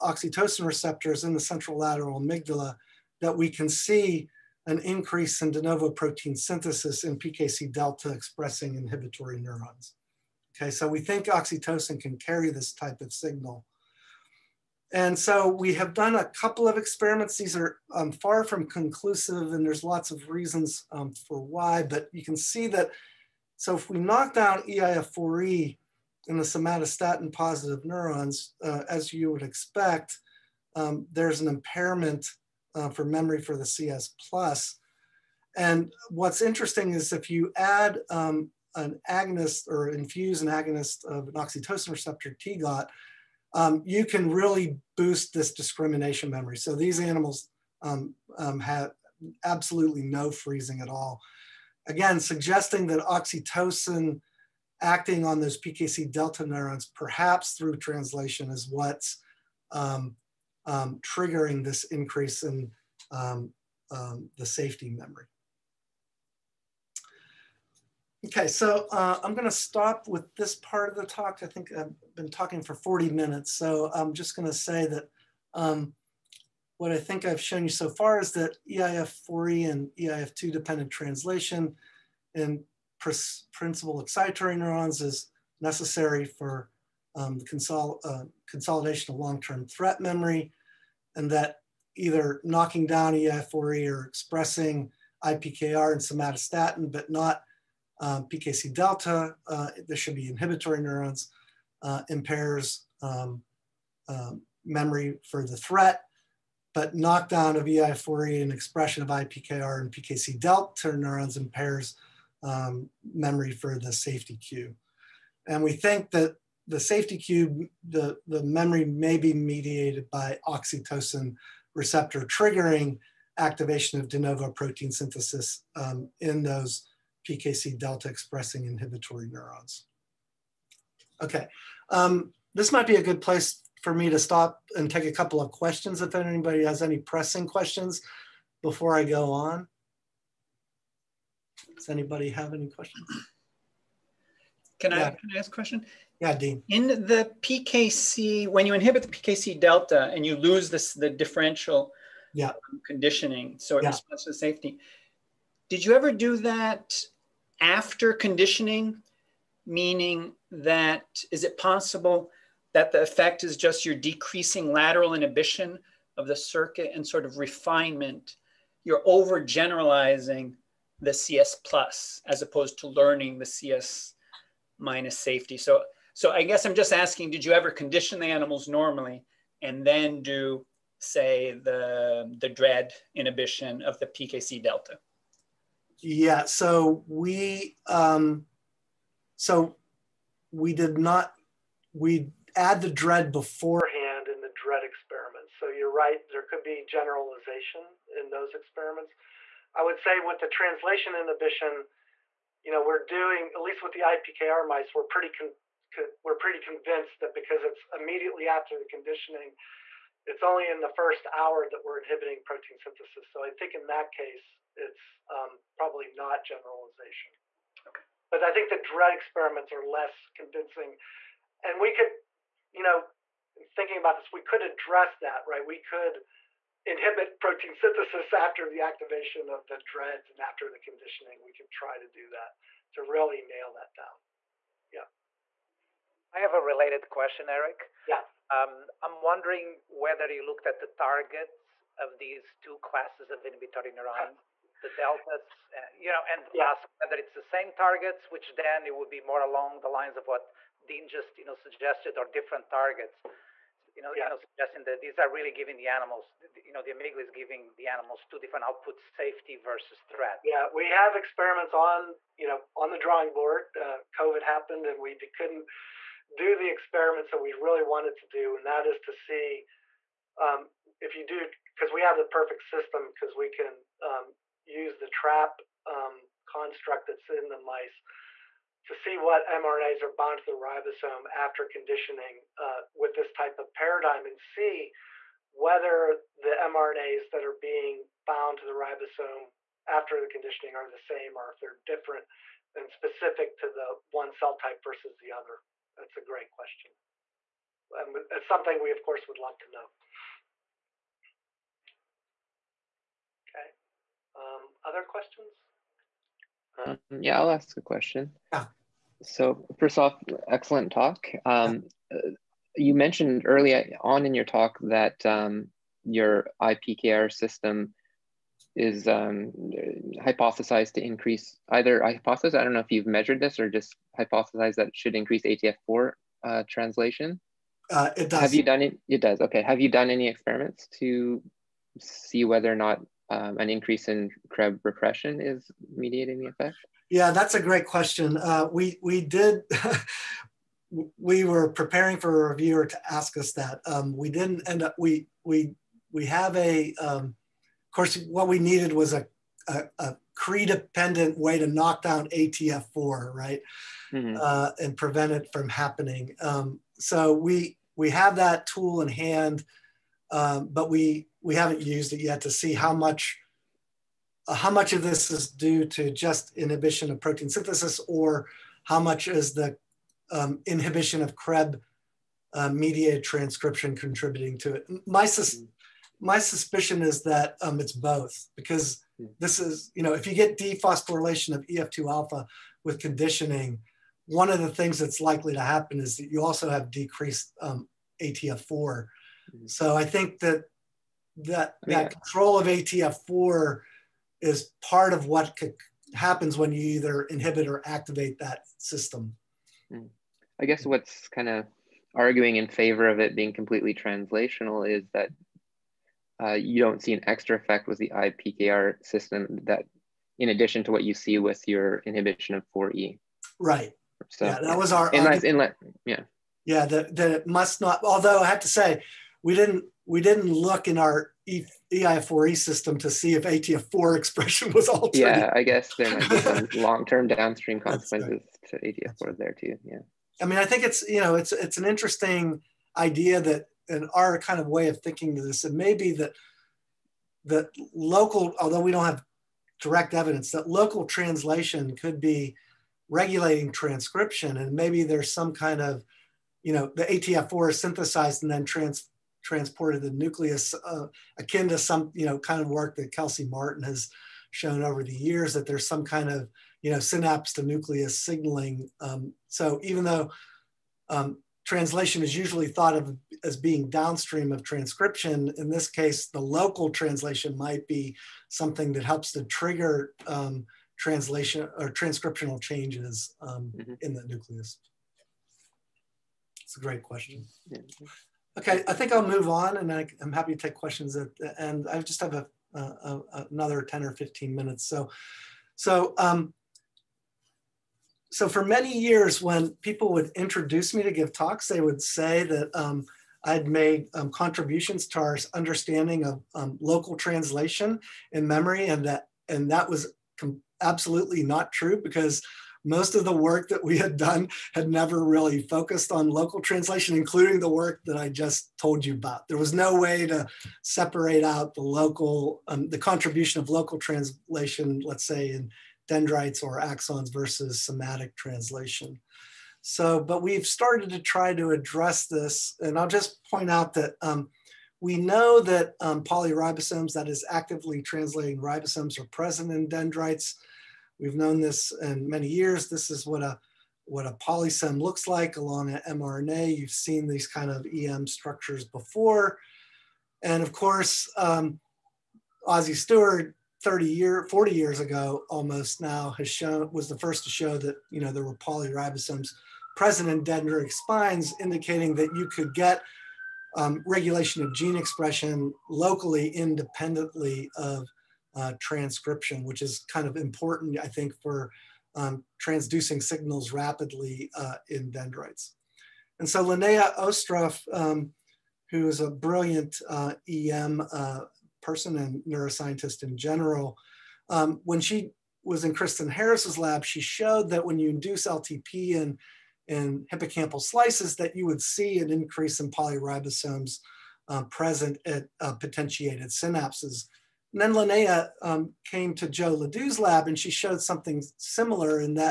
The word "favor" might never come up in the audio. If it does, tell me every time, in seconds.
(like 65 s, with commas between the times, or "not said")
402 s.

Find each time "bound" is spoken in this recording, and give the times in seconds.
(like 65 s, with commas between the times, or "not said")
280 s, 288 s.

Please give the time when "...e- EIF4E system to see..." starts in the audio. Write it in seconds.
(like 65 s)
421 s.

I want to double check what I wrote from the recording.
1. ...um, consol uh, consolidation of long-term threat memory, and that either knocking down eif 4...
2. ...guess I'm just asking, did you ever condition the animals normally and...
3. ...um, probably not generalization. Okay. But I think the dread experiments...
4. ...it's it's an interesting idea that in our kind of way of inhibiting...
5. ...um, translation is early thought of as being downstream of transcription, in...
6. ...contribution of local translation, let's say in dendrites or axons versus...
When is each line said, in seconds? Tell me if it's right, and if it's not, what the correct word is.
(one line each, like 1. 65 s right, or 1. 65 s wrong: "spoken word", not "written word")
1. 87 s right
2. 176 s right
3. 215 s right
4. 431 s wrong: "thinking", not "inhibiting"
5. 461 s wrong: "usually", not "early"
6. 512 s right.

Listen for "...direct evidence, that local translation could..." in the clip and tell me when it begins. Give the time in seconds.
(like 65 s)
439 s.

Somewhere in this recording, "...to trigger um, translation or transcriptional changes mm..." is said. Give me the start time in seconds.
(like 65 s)
469 s.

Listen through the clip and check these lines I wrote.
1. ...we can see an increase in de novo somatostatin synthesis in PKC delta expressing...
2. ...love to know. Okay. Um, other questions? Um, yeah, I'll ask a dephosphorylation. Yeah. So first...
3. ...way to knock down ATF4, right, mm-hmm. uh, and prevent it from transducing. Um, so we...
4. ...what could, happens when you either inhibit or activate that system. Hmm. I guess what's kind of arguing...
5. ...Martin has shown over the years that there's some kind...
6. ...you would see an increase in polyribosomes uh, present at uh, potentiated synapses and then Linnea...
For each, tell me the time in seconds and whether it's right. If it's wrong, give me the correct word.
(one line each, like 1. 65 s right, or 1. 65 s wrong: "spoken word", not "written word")
1. 3 s wrong: "protein", not "somatostatin"
2. 299 s wrong: "question", not "dephosphorylation"
3. 351 s wrong: "happening", not "transducing"
4. 395 s right
5. 453 s right
6. 581 s right.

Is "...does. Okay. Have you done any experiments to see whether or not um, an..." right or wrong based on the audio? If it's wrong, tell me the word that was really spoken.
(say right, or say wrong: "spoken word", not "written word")
right.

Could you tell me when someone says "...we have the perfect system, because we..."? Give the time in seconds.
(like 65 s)
271 s.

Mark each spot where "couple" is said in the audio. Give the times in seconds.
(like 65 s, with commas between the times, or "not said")
16 s, 135 s.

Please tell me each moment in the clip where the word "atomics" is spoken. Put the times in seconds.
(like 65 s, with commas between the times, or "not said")
not said.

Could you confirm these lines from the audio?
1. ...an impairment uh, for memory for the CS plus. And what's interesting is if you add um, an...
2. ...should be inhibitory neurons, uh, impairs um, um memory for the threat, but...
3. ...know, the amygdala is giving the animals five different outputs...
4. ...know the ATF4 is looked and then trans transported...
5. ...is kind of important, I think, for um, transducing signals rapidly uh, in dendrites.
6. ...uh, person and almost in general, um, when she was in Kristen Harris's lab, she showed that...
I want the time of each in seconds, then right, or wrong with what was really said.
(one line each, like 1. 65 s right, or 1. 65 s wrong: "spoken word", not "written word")
1. 31 s right
2. 99 s right
3. 256 s wrong: "two", not "five"
4. 446 s wrong: "synthesized", not "looked"
5. 559 s right
6. 571 s wrong: "neuroscientist", not "almost".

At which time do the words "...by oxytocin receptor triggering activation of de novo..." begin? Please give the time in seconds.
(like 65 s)
120 s.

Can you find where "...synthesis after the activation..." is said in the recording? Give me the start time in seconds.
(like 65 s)
227 s.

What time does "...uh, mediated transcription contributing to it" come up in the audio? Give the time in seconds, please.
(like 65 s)
372 s.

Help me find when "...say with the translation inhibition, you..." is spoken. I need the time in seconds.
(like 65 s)
199 s.